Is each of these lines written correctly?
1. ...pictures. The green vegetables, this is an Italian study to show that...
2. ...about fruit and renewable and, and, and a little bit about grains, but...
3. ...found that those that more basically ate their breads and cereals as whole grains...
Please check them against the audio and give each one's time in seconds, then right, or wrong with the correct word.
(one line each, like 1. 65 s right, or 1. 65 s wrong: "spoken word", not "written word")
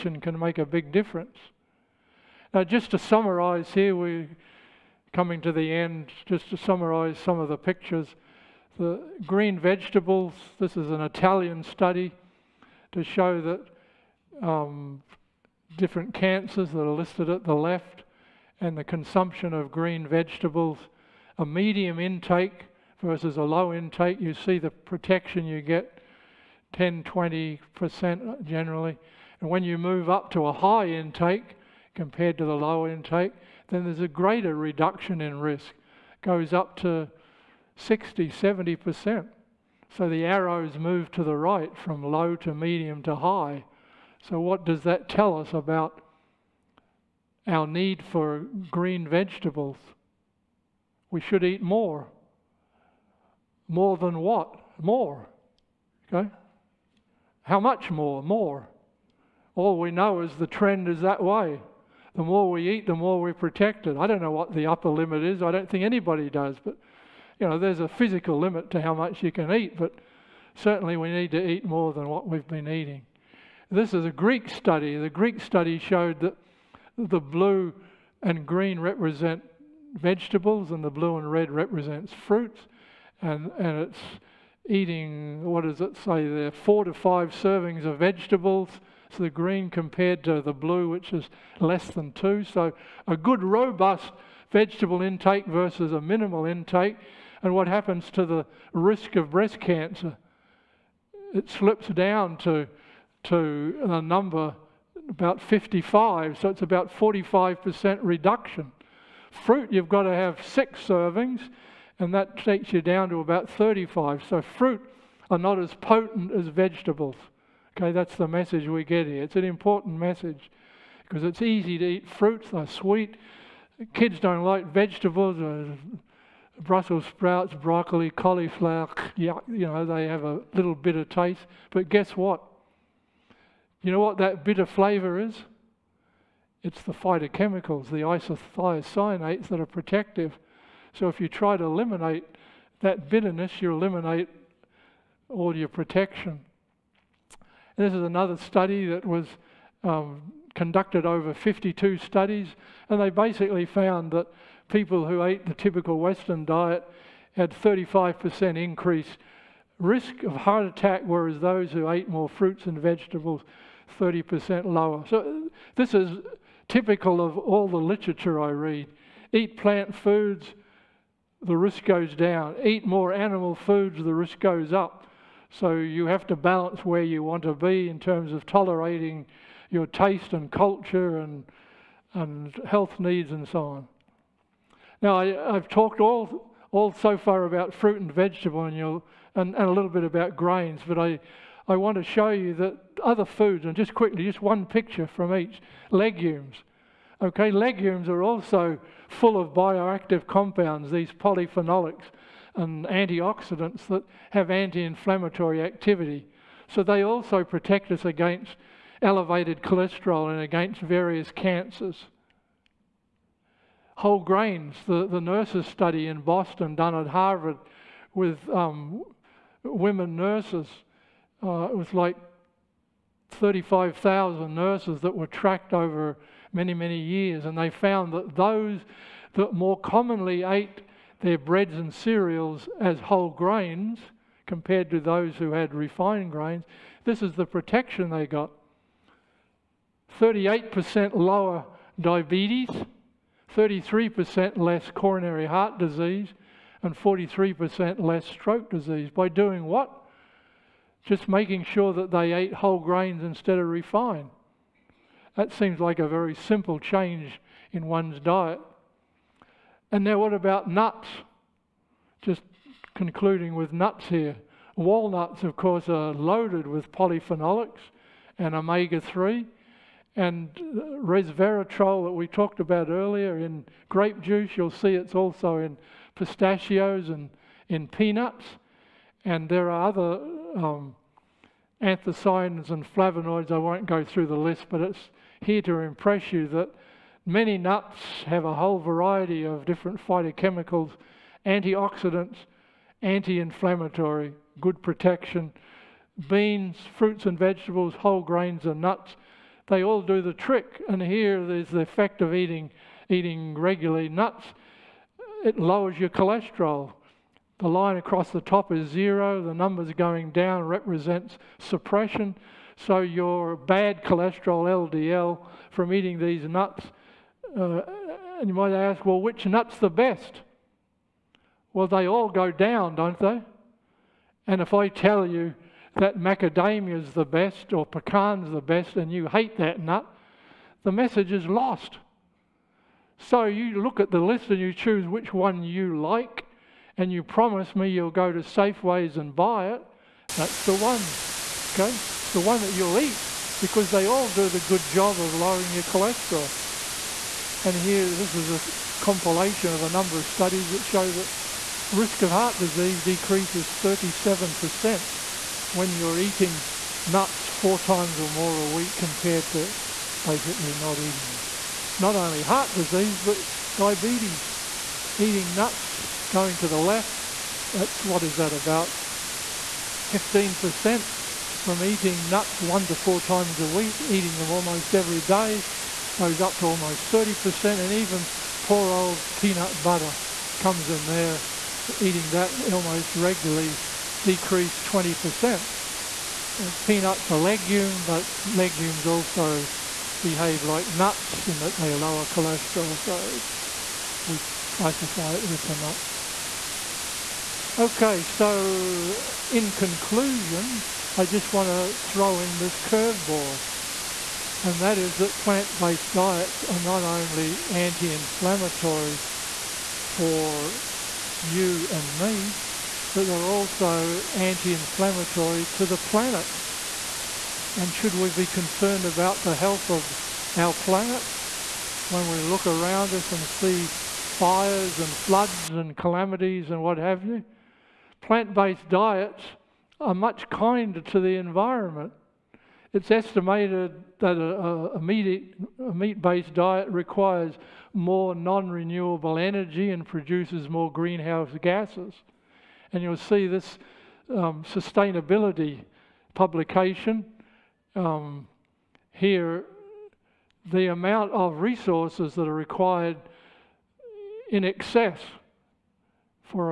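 1. 7 s right
2. 187 s wrong: "vegetable", not "renewable"
3. 227 s wrong: "commonly", not "basically".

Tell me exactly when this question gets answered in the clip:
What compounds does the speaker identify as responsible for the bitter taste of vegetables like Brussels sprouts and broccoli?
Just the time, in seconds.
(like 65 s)
138 s.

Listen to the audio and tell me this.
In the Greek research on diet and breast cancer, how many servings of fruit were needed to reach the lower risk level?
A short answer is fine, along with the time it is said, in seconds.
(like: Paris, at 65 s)
6, at 110 s.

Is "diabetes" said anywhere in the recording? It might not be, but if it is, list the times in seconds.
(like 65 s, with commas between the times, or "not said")
241 s, 363 s.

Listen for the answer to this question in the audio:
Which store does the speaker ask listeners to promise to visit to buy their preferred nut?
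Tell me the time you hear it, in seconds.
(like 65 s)
338 s.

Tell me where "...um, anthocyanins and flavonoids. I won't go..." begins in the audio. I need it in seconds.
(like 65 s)
280 s.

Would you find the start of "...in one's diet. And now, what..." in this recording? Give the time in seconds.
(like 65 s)
257 s.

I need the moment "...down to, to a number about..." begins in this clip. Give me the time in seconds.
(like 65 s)
101 s.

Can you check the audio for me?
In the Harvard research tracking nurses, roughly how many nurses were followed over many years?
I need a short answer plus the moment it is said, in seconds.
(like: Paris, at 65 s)
35,000, at 223 s.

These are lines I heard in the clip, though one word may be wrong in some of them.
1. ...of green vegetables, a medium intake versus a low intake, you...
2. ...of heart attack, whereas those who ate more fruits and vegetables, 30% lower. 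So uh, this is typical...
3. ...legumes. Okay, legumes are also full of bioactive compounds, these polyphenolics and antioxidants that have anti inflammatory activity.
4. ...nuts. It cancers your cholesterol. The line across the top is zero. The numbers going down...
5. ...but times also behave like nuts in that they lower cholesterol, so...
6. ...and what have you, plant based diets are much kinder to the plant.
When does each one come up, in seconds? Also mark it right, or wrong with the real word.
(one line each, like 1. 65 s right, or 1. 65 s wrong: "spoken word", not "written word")
1. 19 s right
2. 160 s right
3. 195 s right
4. 304 s wrong: "lowers", not "cancers"
5. 388 s wrong: "legumes", not "times"
6. 426 s wrong: "environment", not "plant".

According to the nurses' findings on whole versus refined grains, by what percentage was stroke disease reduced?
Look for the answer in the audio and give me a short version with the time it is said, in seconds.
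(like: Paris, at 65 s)
43%, at 246 s.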